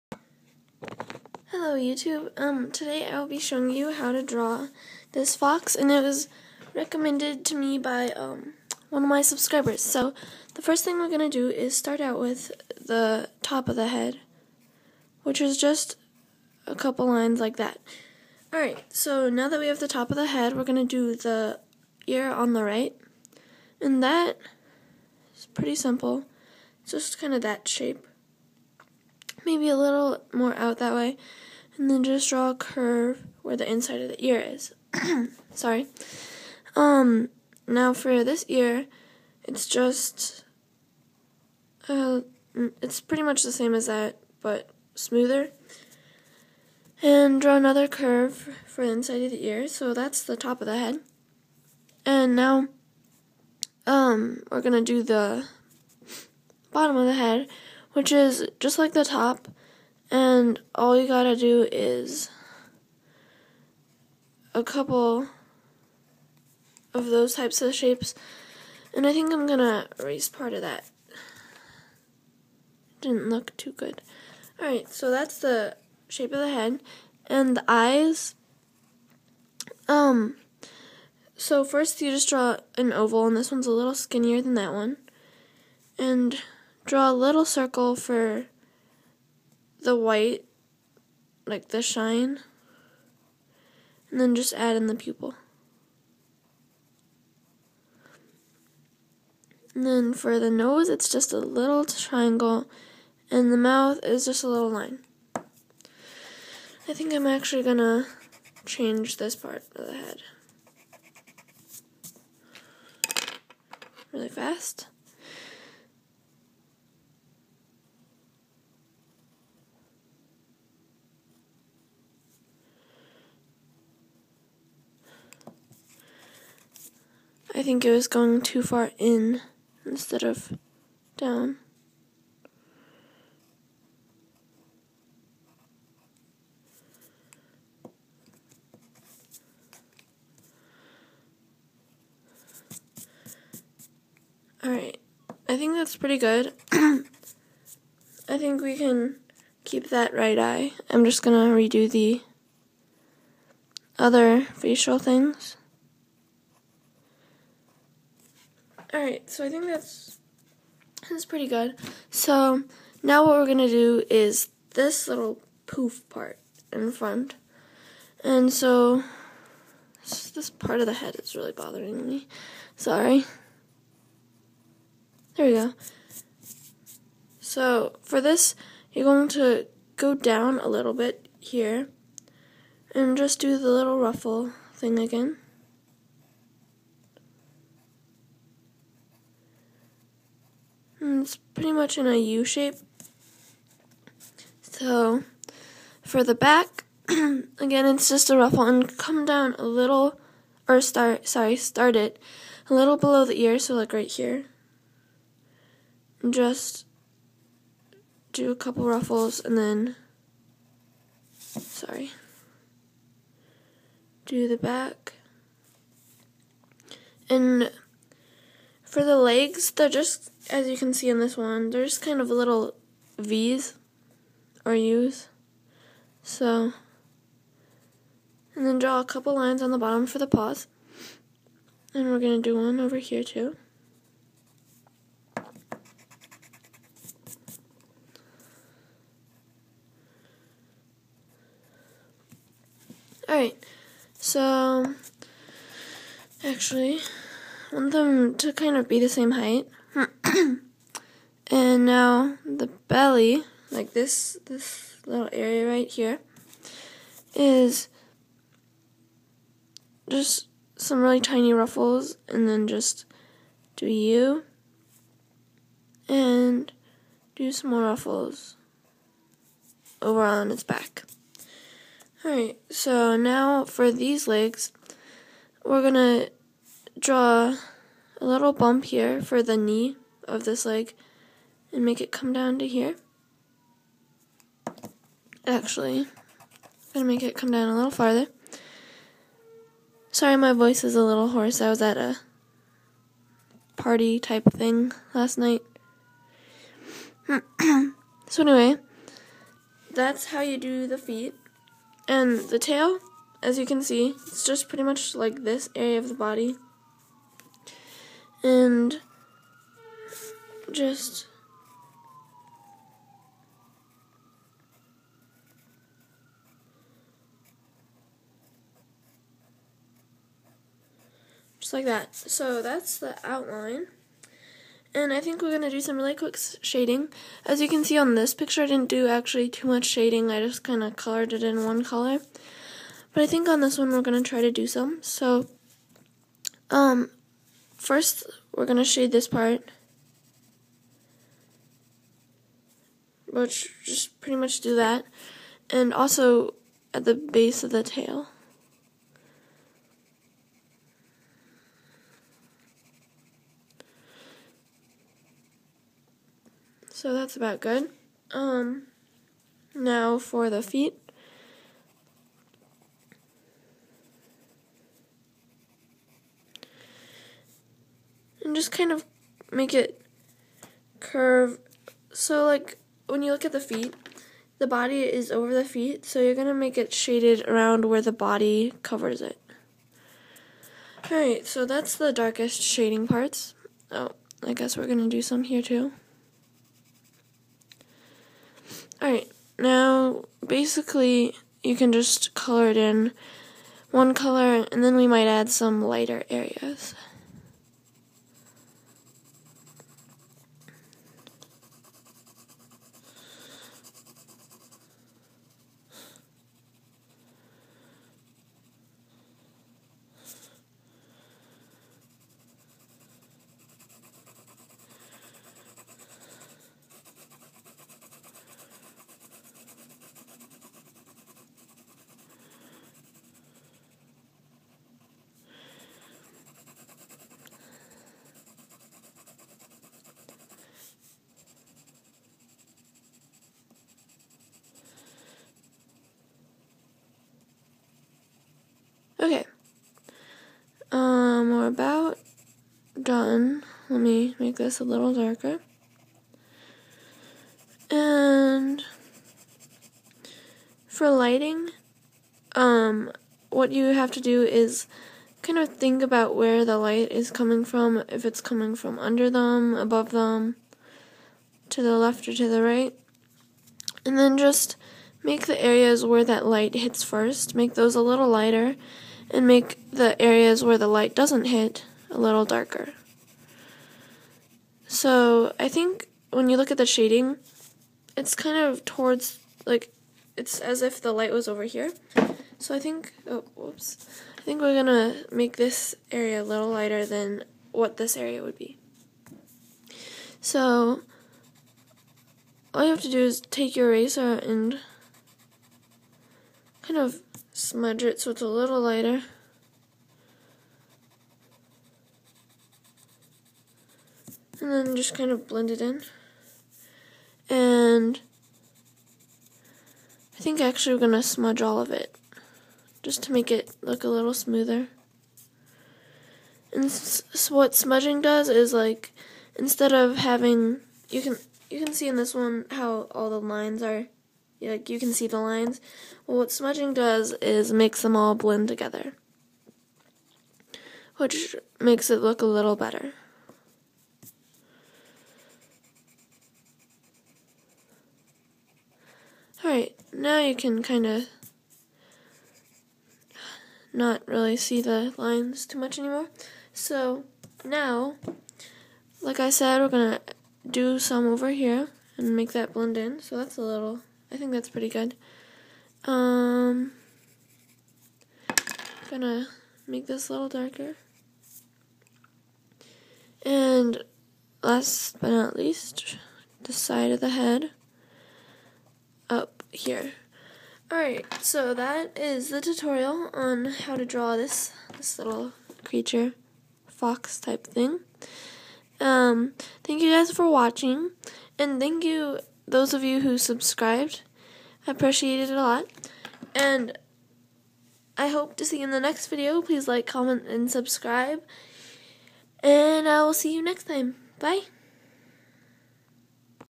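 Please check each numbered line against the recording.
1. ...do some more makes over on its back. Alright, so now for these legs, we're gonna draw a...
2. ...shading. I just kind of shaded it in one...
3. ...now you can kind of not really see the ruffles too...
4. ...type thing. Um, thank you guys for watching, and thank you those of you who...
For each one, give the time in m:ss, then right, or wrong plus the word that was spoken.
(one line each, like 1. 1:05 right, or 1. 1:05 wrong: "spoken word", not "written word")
1. 4:27 wrong: "ruffles", not "makes"
2. 5:29 wrong: "colored", not "shaded"
3. 9:00 wrong: "lines", not "ruffles"
4. 9:37 right.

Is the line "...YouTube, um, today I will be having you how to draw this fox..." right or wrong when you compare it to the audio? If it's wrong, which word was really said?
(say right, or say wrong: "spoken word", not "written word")
wrong: "showing", not "having".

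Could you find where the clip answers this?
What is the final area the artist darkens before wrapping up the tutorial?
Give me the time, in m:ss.
9:26.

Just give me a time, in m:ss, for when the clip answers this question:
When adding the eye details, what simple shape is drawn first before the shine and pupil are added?
1:22.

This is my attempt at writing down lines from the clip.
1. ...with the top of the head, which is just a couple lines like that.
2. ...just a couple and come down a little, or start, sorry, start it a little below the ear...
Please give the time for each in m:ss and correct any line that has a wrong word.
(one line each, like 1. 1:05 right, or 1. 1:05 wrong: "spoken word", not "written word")
1. 0:12 right
2. 3:18 wrong: "ruffle", not "couple".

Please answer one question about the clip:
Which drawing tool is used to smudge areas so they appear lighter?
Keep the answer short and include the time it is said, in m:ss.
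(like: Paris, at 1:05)
eraser, at 8:13.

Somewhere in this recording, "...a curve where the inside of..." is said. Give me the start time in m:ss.
0:32.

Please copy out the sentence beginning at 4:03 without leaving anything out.
Alright, so actually, want them to kind of be the same height.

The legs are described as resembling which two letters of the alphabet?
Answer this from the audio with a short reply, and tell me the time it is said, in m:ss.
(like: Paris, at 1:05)
V's or U's, at 3:43.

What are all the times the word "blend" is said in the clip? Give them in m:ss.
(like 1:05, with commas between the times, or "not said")
8:25, 8:48, 9:12.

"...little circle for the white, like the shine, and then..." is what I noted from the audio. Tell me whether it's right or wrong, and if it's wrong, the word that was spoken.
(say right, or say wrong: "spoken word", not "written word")
right.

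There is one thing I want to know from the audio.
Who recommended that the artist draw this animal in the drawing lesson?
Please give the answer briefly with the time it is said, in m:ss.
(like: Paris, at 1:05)
one of my subscribers, at 0:08.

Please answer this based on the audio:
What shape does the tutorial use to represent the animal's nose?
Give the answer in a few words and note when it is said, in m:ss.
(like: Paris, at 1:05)
little triangle, at 1:41.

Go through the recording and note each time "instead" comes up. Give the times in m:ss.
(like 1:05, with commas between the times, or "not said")
2:09, 8:39.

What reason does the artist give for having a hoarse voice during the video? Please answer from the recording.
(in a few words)
a party.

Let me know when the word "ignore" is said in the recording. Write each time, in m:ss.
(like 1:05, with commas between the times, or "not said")
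not said.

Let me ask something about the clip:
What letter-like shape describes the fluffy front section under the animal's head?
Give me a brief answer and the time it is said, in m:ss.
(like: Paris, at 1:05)
U shape, at 3:12.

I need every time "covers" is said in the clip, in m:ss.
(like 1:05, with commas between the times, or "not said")
6:18.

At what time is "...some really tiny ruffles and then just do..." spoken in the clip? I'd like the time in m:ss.
4:20.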